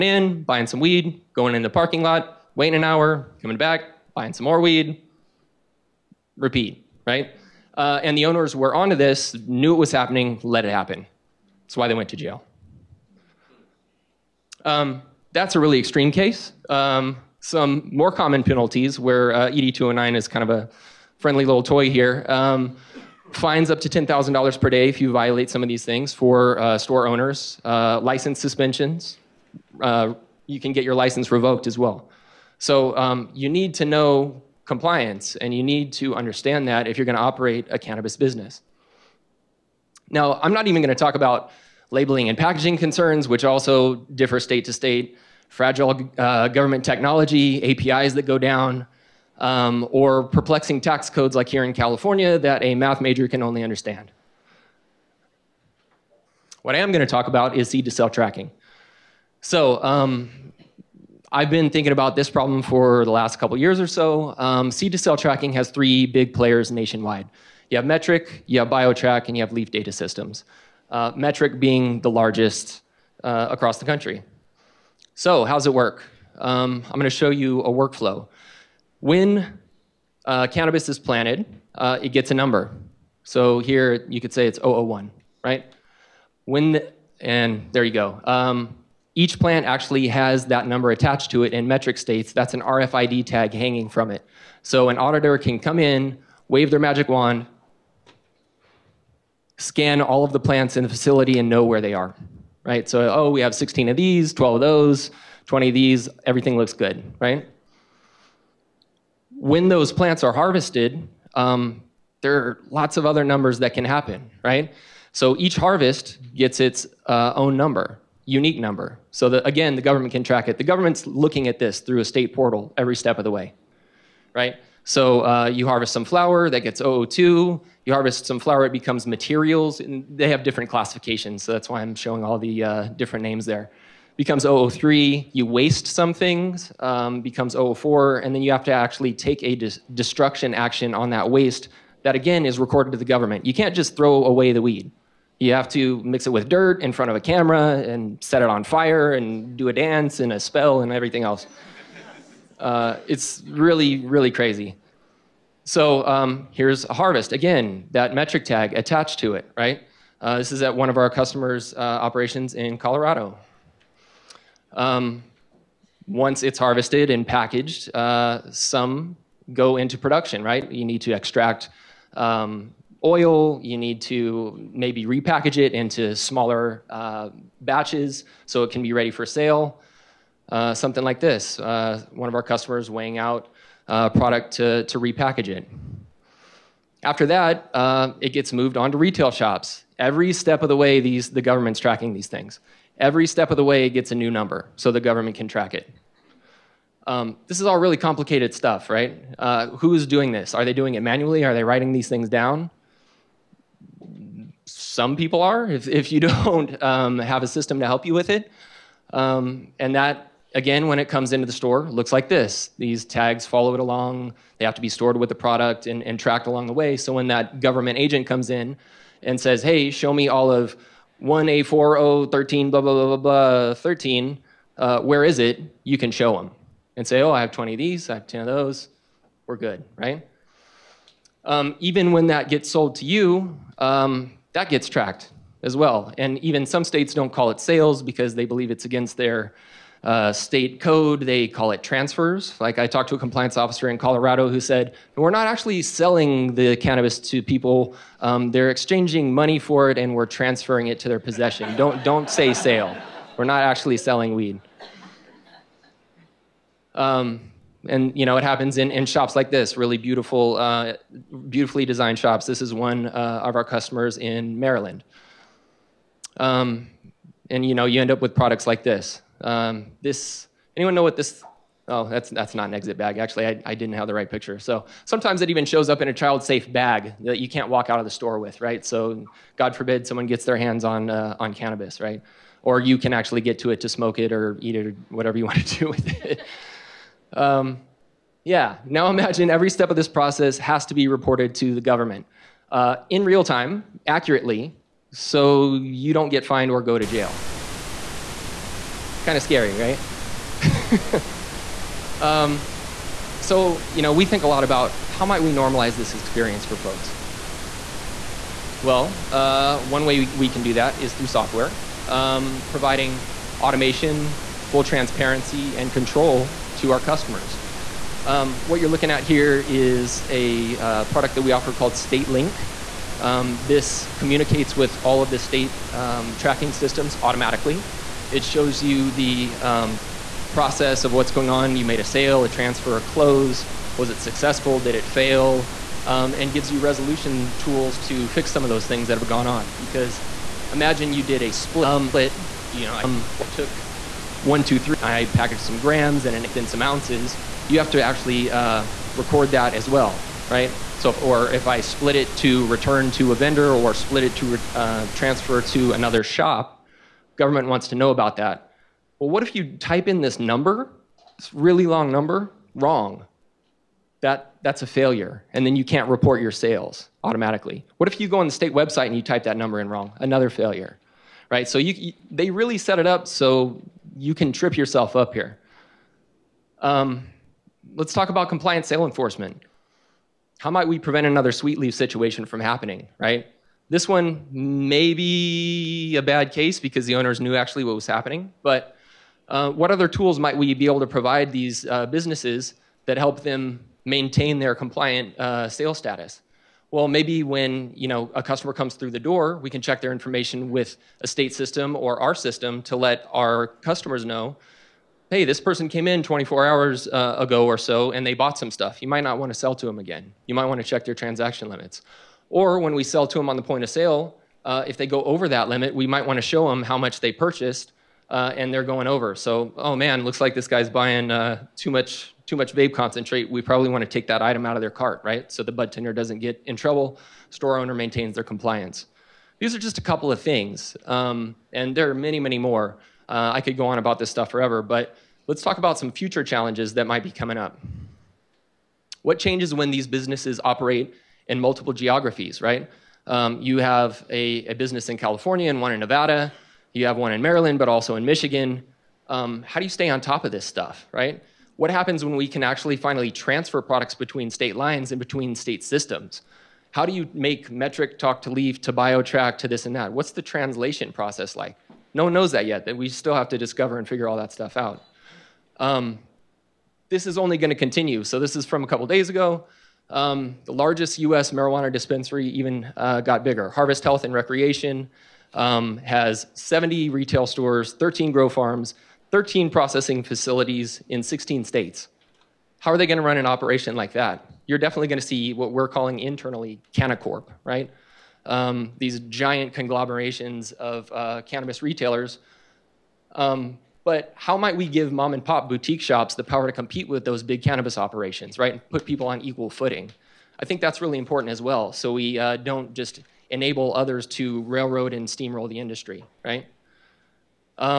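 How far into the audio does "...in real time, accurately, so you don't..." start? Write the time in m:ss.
4:53.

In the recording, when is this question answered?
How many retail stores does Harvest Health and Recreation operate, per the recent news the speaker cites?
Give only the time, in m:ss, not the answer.
7:56.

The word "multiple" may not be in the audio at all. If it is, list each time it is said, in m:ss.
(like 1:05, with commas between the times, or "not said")
7:21.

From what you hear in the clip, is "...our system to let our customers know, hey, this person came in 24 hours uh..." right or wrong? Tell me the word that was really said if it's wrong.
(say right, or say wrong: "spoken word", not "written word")
right.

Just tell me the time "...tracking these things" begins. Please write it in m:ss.
3:11.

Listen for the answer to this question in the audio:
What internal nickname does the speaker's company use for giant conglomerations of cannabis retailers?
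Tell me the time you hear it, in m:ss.
8:06.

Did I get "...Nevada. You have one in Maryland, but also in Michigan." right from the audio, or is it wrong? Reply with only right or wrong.
right.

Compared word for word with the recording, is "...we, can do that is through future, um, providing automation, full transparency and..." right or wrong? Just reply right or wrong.
wrong.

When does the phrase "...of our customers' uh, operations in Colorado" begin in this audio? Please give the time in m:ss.
2:40.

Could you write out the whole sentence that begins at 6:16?
Um, let's talk about compliant sale enforcement.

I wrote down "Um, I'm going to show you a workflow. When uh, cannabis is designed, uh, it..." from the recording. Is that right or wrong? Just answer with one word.
wrong.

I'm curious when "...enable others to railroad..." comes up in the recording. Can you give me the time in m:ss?
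8:23.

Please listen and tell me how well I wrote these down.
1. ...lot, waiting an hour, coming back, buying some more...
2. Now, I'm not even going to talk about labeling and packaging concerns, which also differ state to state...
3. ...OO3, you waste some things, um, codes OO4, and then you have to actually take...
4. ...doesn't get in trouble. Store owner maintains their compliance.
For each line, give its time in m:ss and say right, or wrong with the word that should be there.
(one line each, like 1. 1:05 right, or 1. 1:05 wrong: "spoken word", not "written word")
1. 0:02 right
2. 0:40 right
3. 2:14 wrong: "becomes", not "codes"
4. 7:06 right.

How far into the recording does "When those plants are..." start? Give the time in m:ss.
1:49.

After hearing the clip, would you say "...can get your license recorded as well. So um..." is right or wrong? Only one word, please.
wrong.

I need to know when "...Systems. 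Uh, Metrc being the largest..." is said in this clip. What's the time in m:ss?
1:09.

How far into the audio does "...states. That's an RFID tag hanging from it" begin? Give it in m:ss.
1:31.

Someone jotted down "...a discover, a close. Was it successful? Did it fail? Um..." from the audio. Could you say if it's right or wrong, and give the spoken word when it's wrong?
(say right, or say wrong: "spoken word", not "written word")
wrong: "transfer", not "discover".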